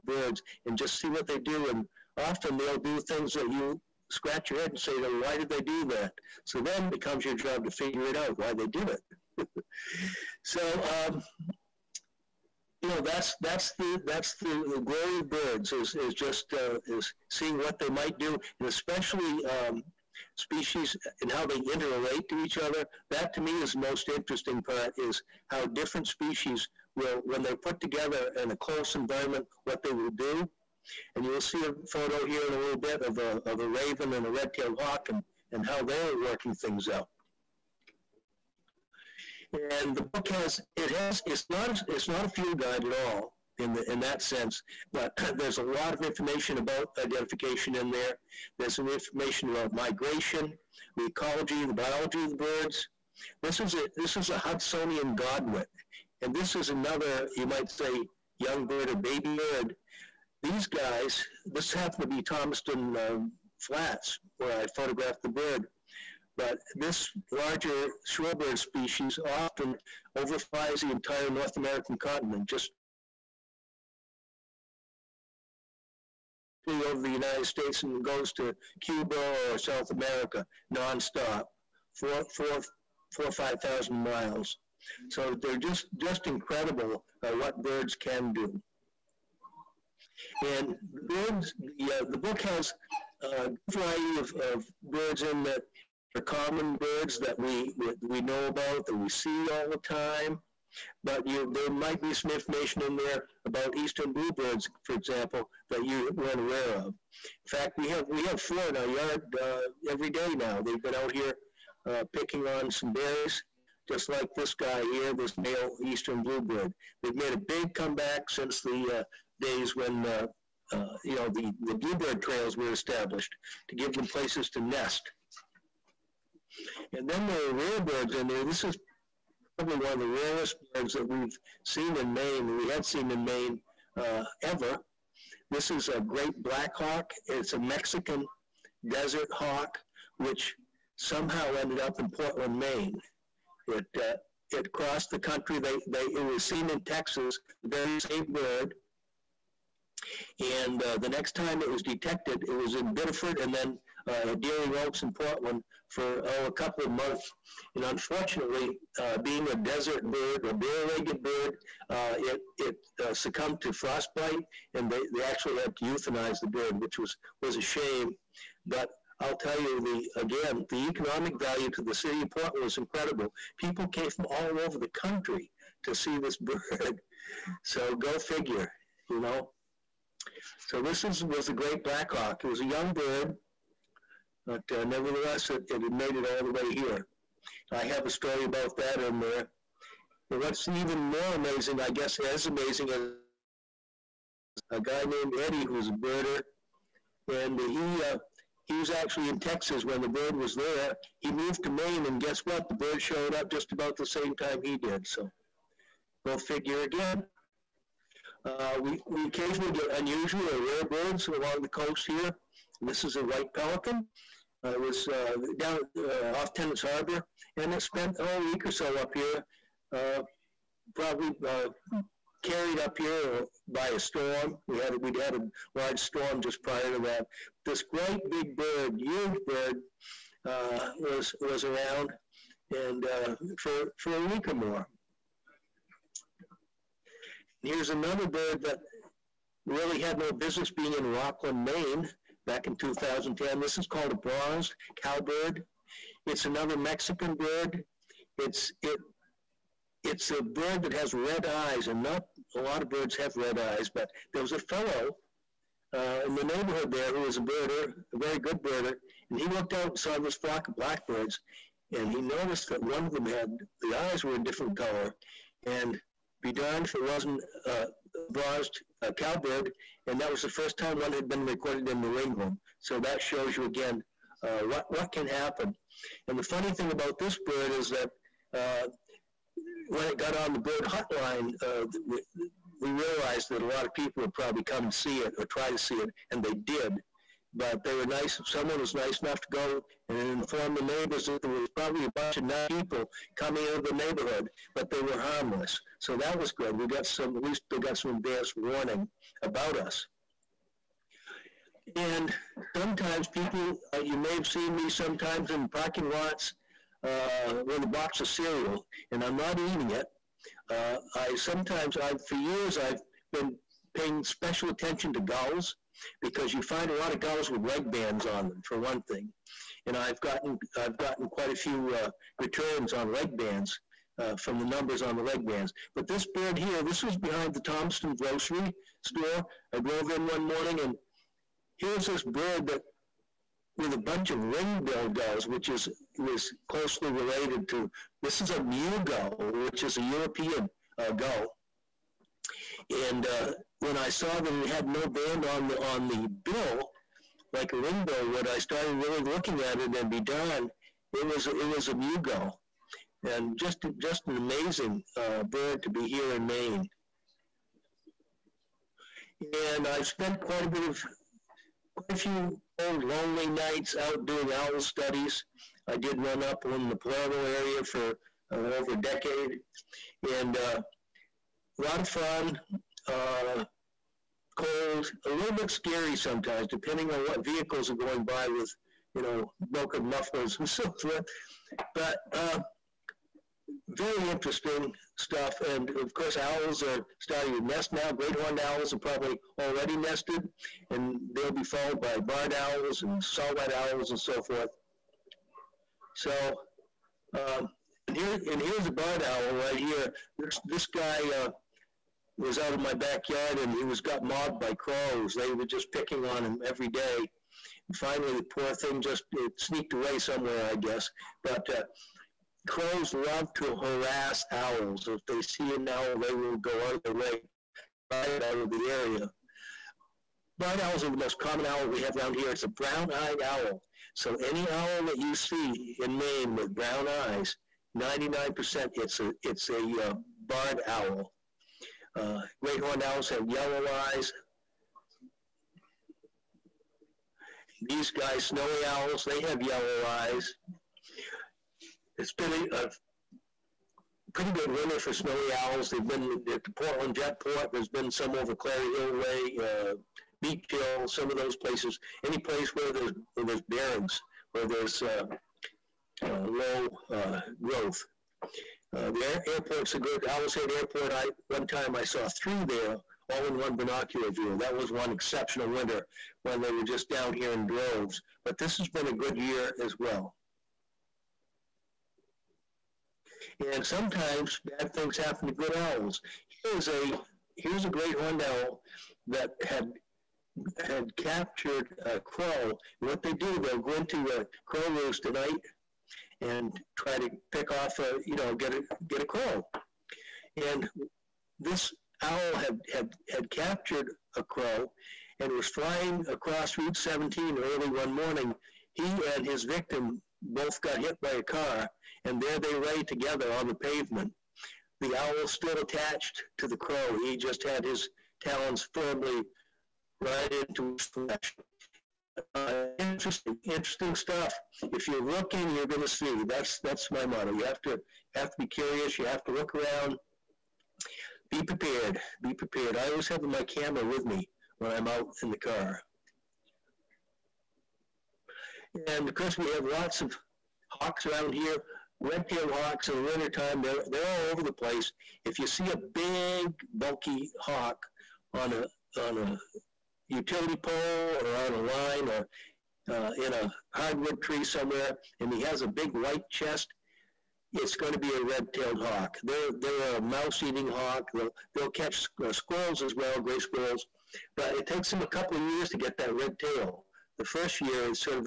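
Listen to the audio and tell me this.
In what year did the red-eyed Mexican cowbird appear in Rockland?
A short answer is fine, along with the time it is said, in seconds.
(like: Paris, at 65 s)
2010, at 242 s.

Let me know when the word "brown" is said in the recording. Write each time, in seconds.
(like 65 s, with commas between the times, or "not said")
422 s, 426 s.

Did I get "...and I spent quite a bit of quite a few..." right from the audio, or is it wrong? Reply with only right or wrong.
right.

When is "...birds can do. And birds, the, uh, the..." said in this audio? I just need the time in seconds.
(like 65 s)
87 s.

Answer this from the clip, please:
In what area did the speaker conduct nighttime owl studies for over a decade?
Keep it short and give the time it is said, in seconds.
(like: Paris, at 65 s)
Palermo, at 366 s.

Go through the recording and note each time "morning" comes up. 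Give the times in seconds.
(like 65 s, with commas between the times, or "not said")
330 s, 498 s.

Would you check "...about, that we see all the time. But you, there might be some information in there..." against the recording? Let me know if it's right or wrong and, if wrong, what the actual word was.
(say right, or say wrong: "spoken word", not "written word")
right.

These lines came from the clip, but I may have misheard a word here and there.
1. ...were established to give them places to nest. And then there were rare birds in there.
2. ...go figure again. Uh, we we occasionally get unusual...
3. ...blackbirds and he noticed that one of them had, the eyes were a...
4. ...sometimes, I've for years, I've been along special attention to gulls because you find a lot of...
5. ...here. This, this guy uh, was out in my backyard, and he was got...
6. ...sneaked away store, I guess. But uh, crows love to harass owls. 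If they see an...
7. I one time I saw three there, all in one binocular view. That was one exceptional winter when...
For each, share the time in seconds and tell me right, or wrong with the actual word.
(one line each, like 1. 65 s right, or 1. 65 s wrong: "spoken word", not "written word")
1. 122 s right
2. 206 s right
3. 260 s right
4. 311 s wrong: "paying", not "along"
5. 399 s right
6. 409 s wrong: "somewhere", not "store"
7. 461 s right.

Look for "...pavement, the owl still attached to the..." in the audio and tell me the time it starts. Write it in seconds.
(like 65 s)
503 s.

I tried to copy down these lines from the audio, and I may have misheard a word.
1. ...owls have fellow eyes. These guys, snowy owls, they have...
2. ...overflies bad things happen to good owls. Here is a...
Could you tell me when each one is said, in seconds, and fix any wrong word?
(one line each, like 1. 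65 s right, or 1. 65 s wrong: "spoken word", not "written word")
1. 433 s wrong: "yellow", not "fellow"
2. 473 s wrong: "sometimes", not "overflies".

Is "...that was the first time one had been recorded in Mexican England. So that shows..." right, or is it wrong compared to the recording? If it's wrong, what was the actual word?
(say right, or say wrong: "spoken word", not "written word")
wrong: "New", not "Mexican".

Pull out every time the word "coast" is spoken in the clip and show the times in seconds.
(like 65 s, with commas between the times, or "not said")
211 s.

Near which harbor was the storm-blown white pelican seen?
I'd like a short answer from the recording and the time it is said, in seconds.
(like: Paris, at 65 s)
Tenants Harbor, at 216 s.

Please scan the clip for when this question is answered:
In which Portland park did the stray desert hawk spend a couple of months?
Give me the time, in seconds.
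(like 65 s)
154 s.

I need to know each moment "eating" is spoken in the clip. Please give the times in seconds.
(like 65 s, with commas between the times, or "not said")
309 s, 550 s.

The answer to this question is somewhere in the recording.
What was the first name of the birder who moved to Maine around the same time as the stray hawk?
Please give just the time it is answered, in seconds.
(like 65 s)
195 s.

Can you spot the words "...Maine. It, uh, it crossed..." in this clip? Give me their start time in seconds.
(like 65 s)
142 s.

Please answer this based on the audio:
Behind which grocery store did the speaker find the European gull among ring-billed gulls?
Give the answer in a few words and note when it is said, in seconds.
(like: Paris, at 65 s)
Thompson Grocery, at 327 s.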